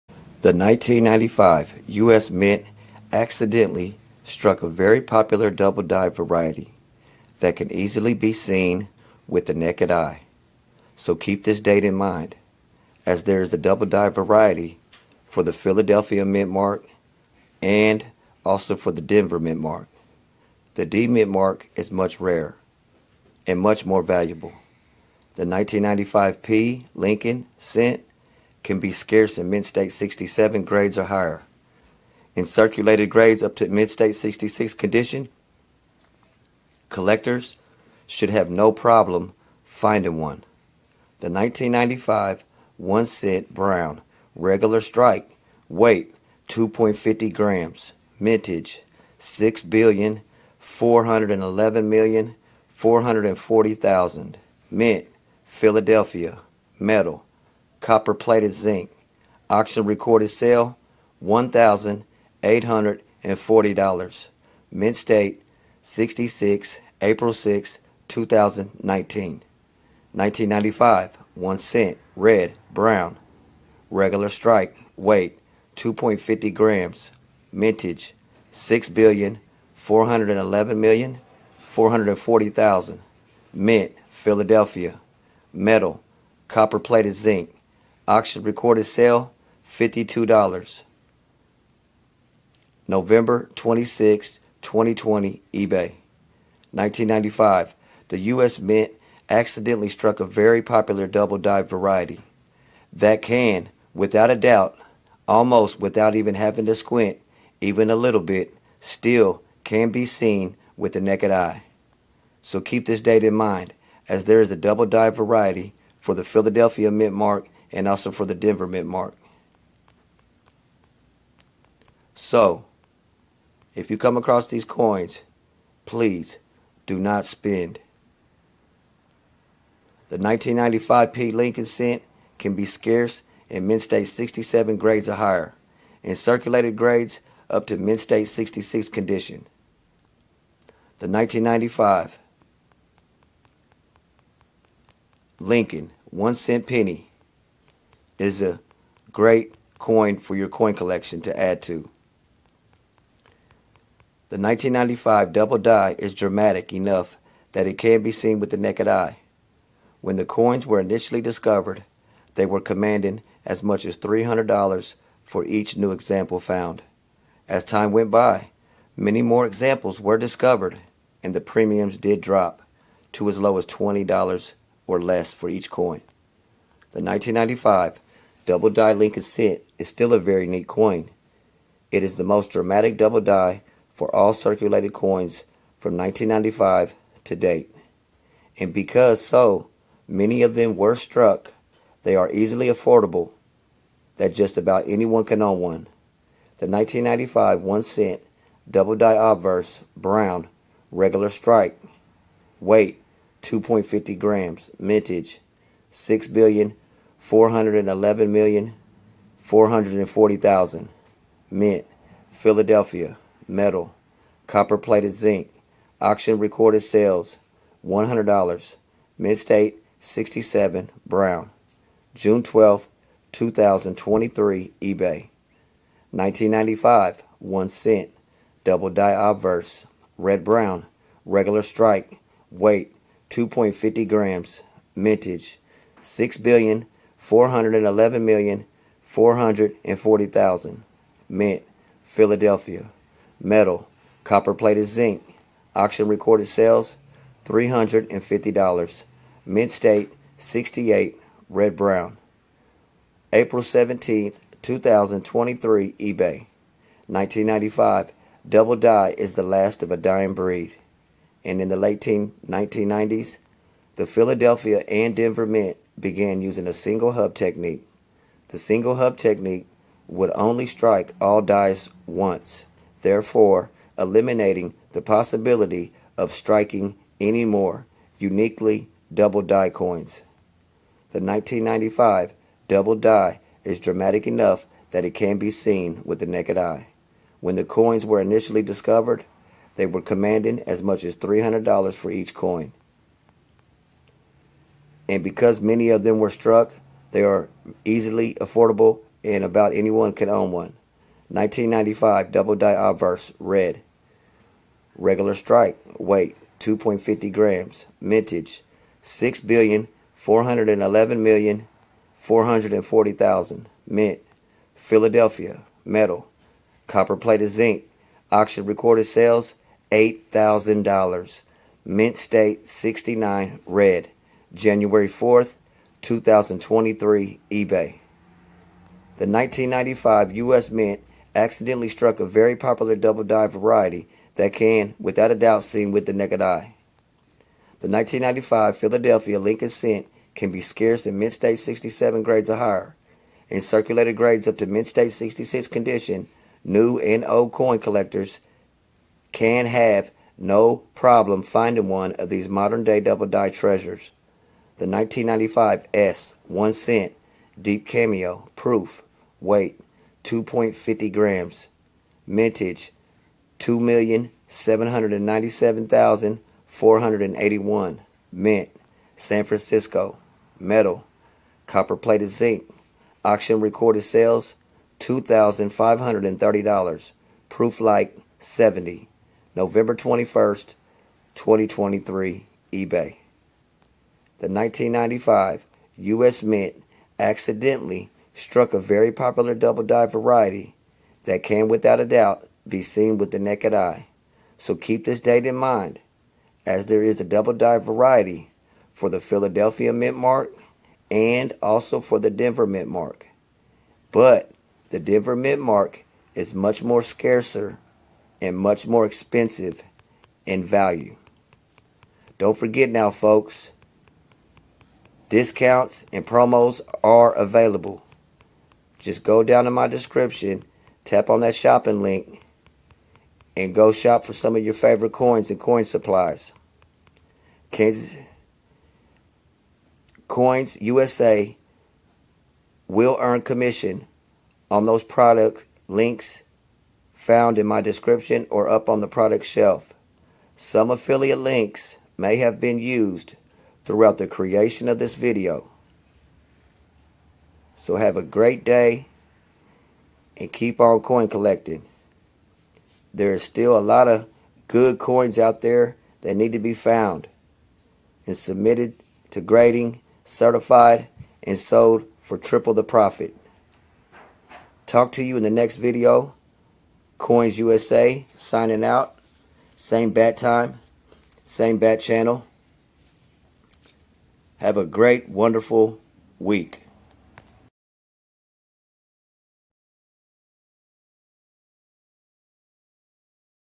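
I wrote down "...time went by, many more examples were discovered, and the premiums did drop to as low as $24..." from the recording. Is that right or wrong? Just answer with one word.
wrong.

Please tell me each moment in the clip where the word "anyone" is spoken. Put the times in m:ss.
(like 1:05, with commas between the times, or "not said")
3:14, 4:59.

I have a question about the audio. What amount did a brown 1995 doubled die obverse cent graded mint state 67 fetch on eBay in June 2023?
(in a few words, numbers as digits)
$100.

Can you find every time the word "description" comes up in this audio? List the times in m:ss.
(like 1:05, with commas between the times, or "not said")
6:59, 7:17.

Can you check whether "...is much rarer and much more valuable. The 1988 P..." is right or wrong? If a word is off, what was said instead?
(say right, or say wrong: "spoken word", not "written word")
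wrong: "1995", not "1988".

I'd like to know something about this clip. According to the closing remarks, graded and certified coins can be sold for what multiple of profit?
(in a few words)
triple.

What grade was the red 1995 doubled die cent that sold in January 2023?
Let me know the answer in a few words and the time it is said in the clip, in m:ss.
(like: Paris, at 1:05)
Mint State 69, at 5:21.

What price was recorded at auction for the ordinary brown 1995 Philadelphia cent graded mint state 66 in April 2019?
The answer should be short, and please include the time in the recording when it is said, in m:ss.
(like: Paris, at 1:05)
$1,840, at 1:01.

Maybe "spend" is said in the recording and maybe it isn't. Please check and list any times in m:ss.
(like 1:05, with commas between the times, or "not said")
2:07.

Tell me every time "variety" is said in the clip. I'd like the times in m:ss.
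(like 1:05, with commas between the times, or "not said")
0:06, 0:14, 1:41, 1:55, 5:33, 6:30, 6:37.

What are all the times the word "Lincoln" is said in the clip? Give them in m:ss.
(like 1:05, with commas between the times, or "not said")
0:26, 2:11, 2:25, 2:58, 5:39.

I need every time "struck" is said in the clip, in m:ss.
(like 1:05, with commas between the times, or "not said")
0:04, 1:39, 3:10, 4:56, 5:31, 6:28.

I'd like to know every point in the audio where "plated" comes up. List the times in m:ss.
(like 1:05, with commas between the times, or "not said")
0:58, 1:26, 3:34, 5:17.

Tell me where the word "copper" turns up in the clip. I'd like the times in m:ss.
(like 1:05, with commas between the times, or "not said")
0:57, 1:26, 3:34, 5:16.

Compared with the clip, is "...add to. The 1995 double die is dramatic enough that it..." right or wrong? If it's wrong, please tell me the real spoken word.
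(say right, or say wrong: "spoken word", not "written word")
right.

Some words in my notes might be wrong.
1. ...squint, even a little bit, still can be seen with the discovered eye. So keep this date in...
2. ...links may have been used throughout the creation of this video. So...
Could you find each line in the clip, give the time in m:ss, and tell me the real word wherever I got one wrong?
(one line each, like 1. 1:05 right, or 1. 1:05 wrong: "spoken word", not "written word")
1. 1:46 wrong: "naked", not "discovered"
2. 7:21 right.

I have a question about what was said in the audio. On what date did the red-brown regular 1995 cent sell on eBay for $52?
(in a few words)
November 26, 2020.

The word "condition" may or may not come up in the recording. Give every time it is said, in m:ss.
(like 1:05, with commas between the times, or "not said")
0:34, 2:18, 5:45.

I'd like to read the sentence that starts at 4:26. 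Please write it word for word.
began using a single hub technique.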